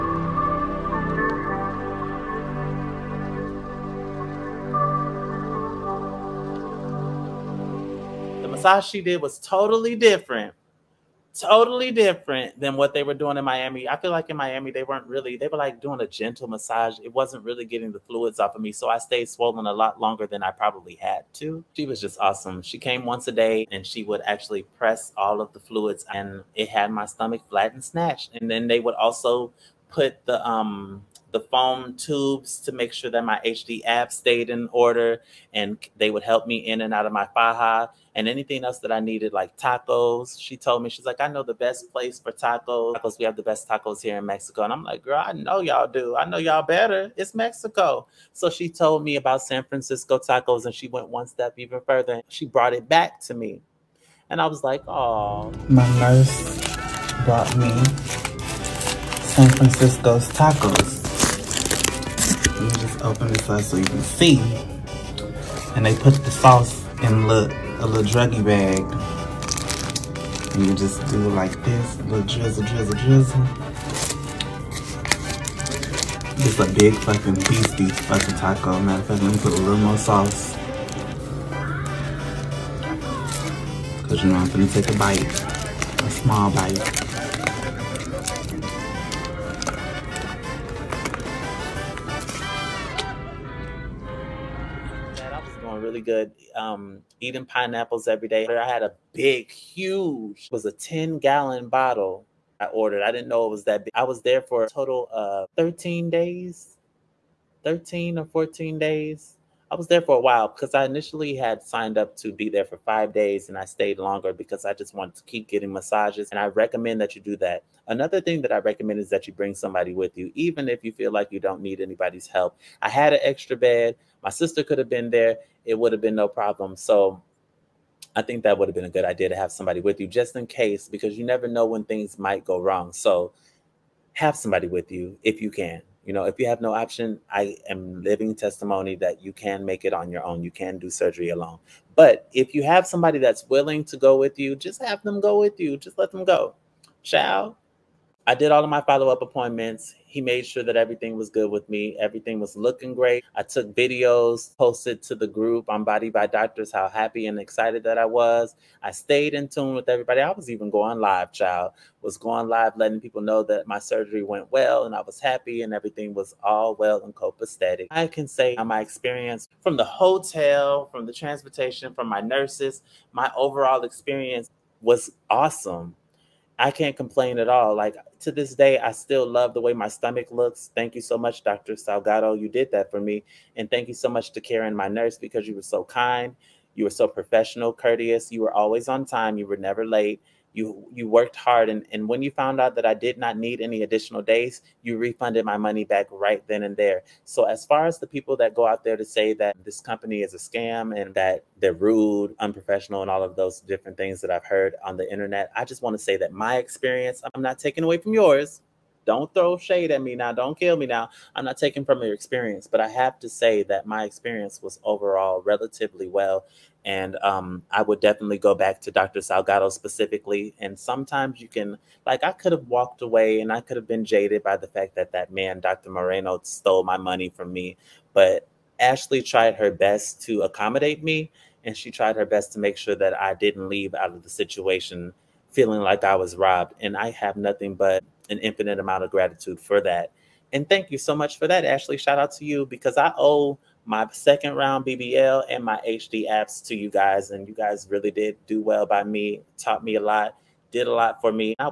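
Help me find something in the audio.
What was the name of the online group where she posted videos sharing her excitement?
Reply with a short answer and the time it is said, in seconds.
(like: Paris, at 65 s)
Body by Doctors, at 155 s.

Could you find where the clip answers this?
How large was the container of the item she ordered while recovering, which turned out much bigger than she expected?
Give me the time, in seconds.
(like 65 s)
100 s.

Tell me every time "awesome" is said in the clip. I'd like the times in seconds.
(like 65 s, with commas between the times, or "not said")
22 s, 175 s.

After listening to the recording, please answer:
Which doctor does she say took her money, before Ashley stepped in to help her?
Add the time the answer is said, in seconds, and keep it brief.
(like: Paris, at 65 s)
Dr. Moreno, at 225 s.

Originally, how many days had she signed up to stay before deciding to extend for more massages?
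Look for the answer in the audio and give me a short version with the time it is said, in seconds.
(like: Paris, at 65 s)
5 days, at 112 s.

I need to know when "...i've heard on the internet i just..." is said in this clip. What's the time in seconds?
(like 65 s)
204 s.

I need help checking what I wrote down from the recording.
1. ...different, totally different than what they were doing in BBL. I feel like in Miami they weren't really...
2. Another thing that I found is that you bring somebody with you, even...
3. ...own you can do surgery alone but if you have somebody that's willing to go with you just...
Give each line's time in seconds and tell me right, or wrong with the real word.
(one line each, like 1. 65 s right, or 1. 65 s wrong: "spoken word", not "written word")
1. 9 s wrong: "Miami", not "BBL"
2. 117 s wrong: "recommend", not "found"
3. 140 s right.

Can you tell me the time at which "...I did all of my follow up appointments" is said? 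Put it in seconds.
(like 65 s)
148 s.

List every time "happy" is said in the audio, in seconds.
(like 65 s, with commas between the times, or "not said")
156 s, 165 s.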